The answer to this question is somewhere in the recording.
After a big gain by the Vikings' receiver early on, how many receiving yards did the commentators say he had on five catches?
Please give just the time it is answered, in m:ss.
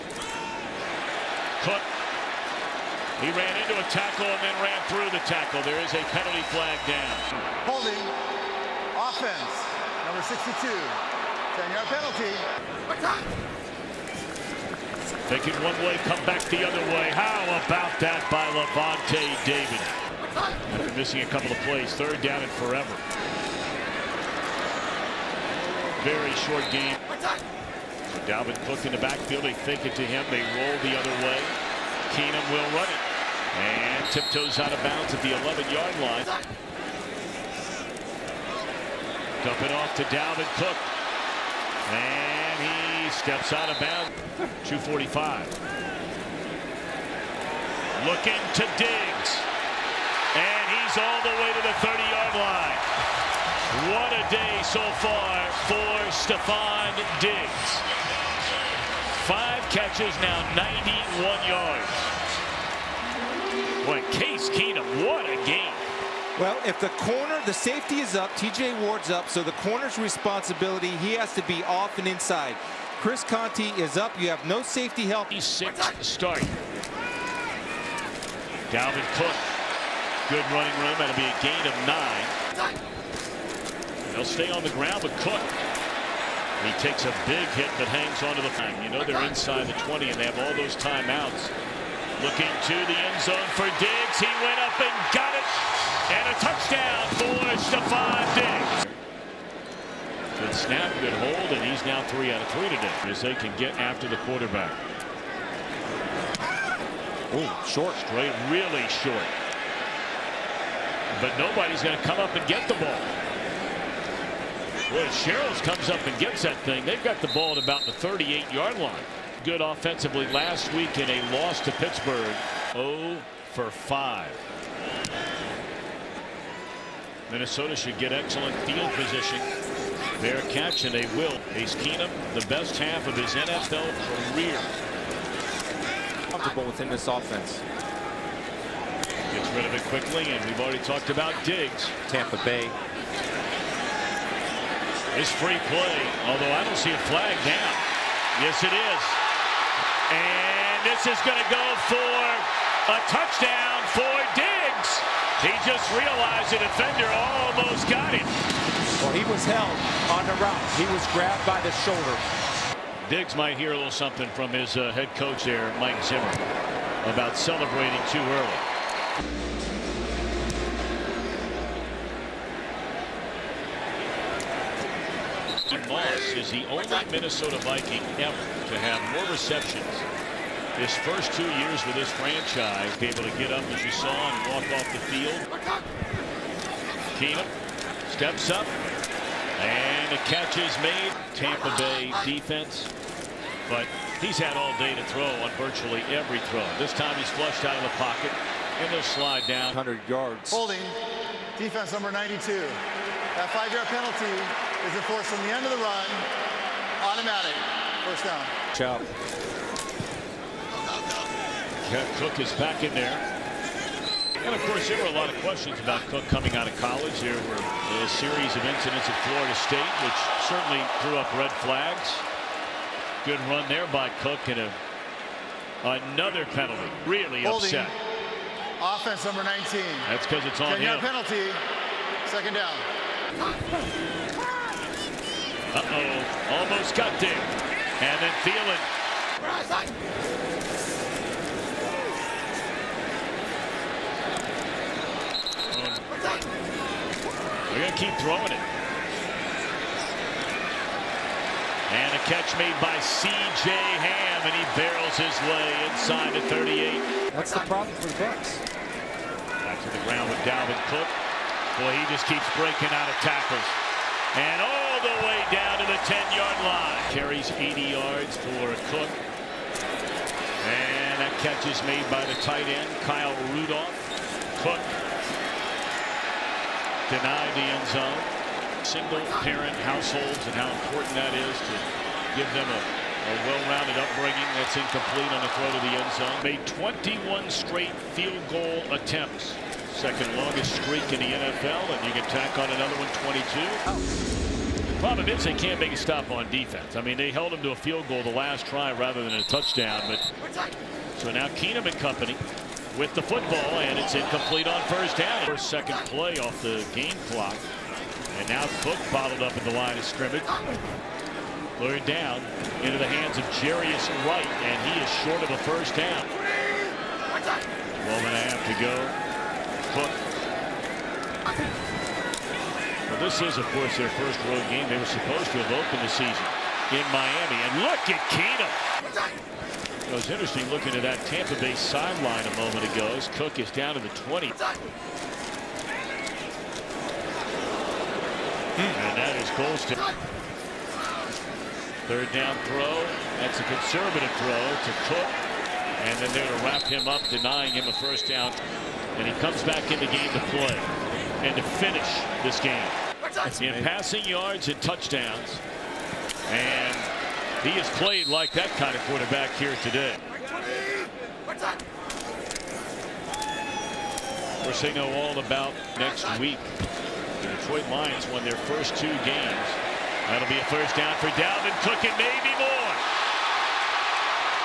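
1:00.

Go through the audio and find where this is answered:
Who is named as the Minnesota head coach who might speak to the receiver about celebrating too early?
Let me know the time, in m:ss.
2:45.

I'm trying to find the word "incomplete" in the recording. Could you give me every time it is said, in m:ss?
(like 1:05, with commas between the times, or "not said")
4:44, 5:04.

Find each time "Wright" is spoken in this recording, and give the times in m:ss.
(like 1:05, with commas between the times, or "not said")
5:14.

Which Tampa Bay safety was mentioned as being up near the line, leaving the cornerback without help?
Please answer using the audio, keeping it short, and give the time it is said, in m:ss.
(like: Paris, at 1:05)
TJ Ward, at 1:08.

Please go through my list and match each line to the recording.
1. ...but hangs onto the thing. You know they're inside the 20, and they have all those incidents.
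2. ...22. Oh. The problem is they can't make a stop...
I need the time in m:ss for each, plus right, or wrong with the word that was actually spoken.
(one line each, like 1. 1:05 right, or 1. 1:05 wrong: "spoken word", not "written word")
1. 1:27 wrong: "timeouts", not "incidents"
2. 4:53 right.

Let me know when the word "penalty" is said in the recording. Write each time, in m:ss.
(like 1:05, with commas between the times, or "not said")
0:06, 0:11, 3:23, 3:46, 3:50.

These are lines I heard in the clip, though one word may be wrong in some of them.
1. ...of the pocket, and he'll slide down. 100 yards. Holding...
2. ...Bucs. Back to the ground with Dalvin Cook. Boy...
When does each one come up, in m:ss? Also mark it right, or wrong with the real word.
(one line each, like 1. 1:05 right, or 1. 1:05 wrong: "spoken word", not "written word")
1. 3:17 right
2. 4:18 right.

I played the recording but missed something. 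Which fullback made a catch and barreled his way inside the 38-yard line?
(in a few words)
C.J. Ham.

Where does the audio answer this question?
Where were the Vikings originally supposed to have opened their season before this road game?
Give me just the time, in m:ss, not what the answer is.
5:27.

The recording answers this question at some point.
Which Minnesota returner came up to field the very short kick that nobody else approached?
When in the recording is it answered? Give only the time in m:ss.
1:55.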